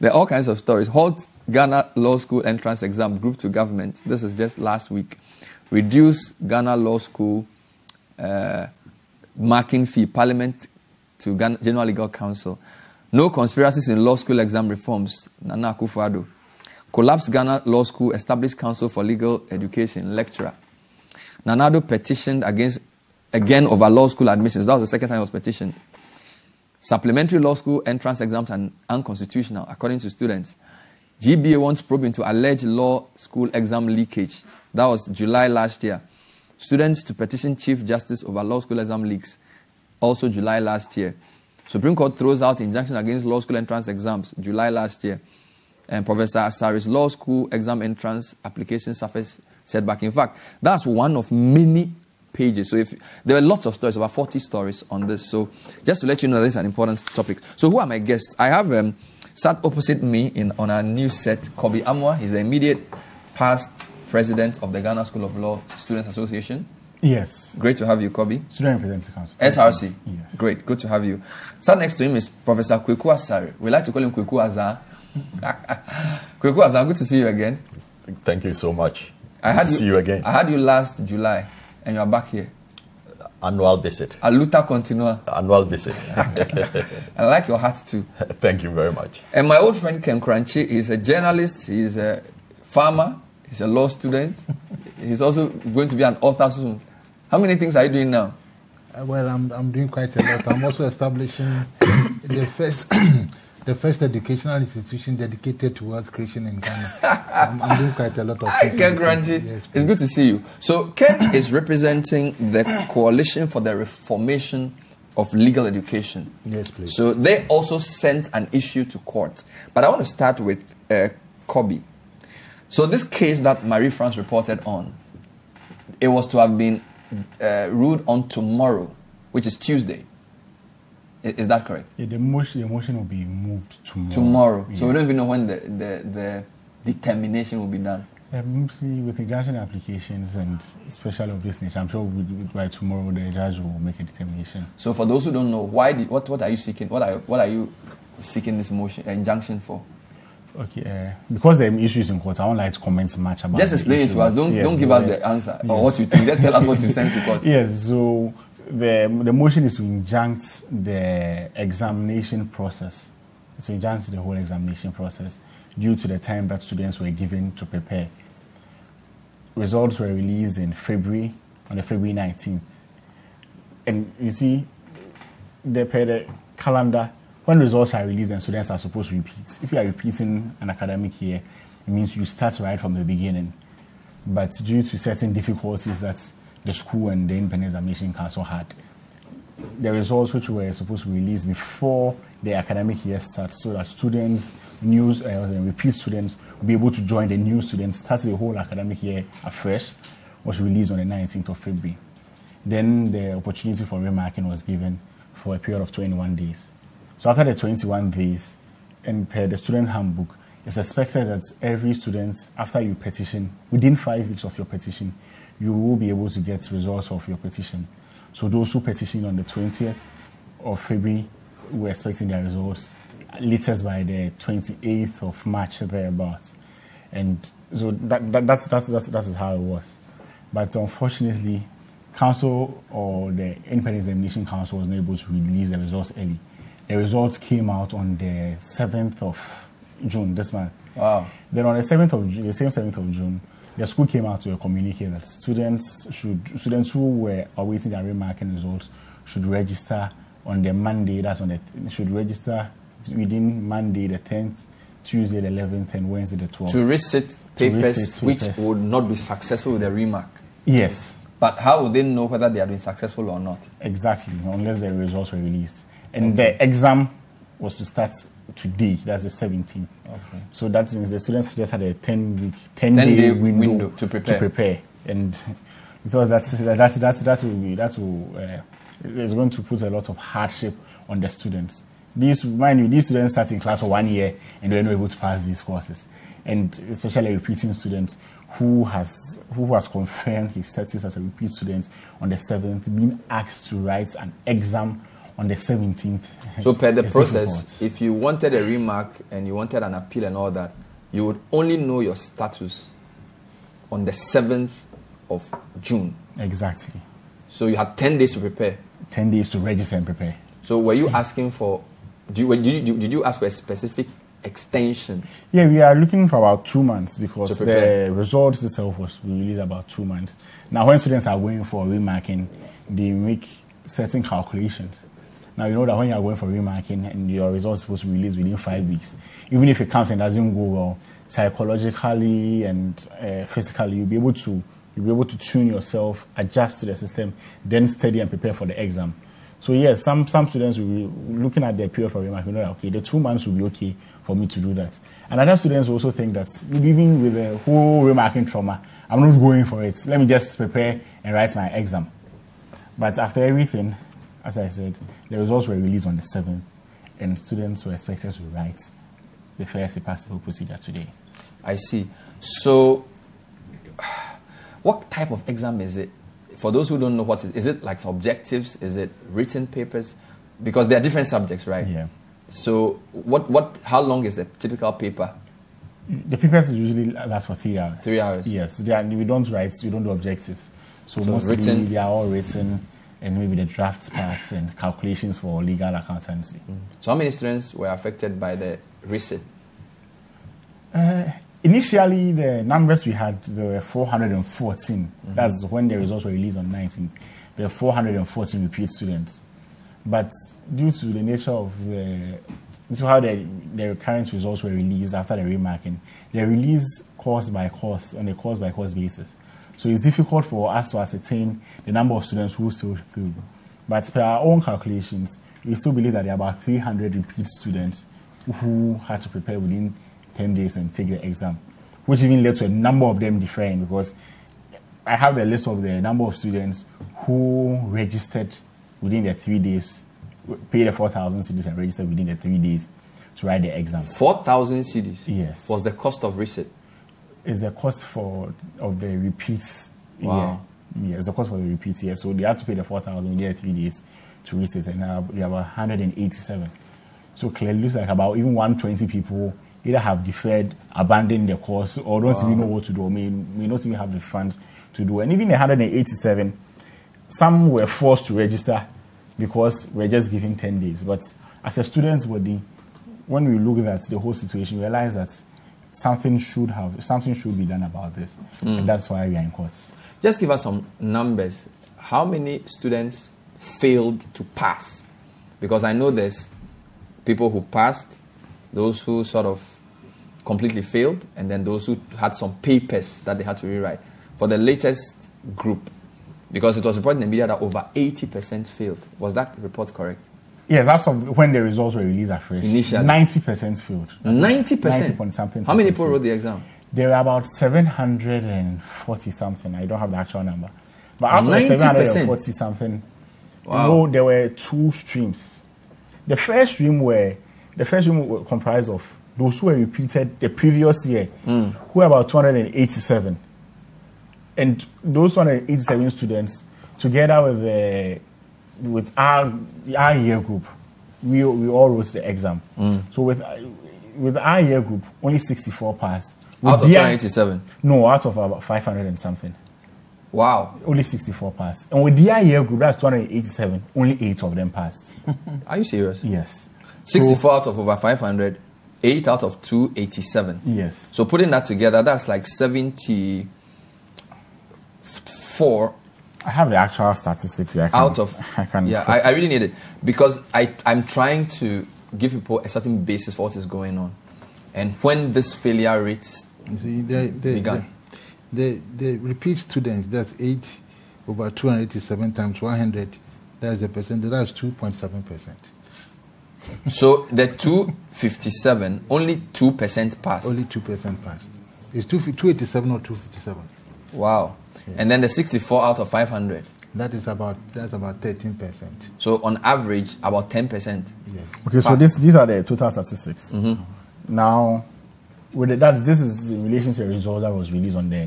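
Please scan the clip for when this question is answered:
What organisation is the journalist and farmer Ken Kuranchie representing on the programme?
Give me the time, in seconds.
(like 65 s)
112 s.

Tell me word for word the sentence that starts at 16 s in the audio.
Collapse Ghana Law School Established Council for Legal Education, lecturer.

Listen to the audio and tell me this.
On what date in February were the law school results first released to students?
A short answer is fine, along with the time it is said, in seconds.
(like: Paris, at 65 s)
February 19th, at 171 s.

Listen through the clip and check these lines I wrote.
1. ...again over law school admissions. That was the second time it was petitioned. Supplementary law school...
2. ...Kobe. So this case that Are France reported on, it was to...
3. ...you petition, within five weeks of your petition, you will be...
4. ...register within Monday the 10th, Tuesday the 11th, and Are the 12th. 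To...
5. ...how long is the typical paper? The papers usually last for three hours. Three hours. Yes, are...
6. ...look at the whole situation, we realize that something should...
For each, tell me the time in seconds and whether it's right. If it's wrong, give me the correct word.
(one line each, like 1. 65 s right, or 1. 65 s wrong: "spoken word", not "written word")
1. 23 s right
2. 121 s wrong: "Marie", not "Are"
3. 212 s right
4. 252 s wrong: "Wednesday", not "Are"
5. 373 s right
6. 463 s right.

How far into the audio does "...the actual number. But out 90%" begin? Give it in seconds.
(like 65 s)
500 s.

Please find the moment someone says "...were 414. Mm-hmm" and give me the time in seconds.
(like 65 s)
393 s.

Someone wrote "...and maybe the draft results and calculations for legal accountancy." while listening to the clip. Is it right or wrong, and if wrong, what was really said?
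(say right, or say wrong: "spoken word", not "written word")
wrong: "parts", not "results".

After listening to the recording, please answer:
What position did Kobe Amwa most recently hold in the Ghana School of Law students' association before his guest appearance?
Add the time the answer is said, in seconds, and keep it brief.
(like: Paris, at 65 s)
Immediate past president, at 62 s.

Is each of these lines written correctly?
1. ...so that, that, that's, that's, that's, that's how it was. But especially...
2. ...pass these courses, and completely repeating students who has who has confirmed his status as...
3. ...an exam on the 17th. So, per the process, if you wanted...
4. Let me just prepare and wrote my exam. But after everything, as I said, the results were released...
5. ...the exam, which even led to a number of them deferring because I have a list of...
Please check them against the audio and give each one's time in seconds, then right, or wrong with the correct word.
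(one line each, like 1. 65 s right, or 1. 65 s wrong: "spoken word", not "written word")
1. 227 s wrong: "unfortunately", not "especially"
2. 285 s wrong: "especially", not "completely"
3. 294 s right
4. 350 s wrong: "write", not "wrote"
5. 421 s right.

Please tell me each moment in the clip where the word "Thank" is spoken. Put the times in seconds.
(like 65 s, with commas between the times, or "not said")
78 s, 88 s.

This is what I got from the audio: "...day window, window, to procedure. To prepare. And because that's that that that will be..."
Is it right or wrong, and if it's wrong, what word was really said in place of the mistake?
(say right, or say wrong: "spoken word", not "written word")
wrong: "prepare", not "procedure".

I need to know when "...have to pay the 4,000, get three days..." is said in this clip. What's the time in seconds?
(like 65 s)
442 s.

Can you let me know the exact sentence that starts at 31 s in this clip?
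GBA wants probe into alleged law school exam leakage.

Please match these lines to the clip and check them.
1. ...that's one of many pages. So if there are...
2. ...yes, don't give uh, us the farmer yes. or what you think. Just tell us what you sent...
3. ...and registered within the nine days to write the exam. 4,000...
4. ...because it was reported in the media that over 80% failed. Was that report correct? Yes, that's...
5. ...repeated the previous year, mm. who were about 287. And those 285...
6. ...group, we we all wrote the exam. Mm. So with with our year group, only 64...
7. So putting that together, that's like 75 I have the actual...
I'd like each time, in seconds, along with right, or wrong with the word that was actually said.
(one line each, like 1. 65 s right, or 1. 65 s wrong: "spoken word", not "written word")
1. 50 s right
2. 154 s wrong: "answer", not "farmer"
3. 431 s wrong: "three", not "nine"
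4. 486 s right
5. 509 s wrong: "287", not "285"
6. 520 s right
7. 541 s wrong: "74", not "75".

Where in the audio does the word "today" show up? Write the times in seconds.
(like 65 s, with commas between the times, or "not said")
268 s, 360 s.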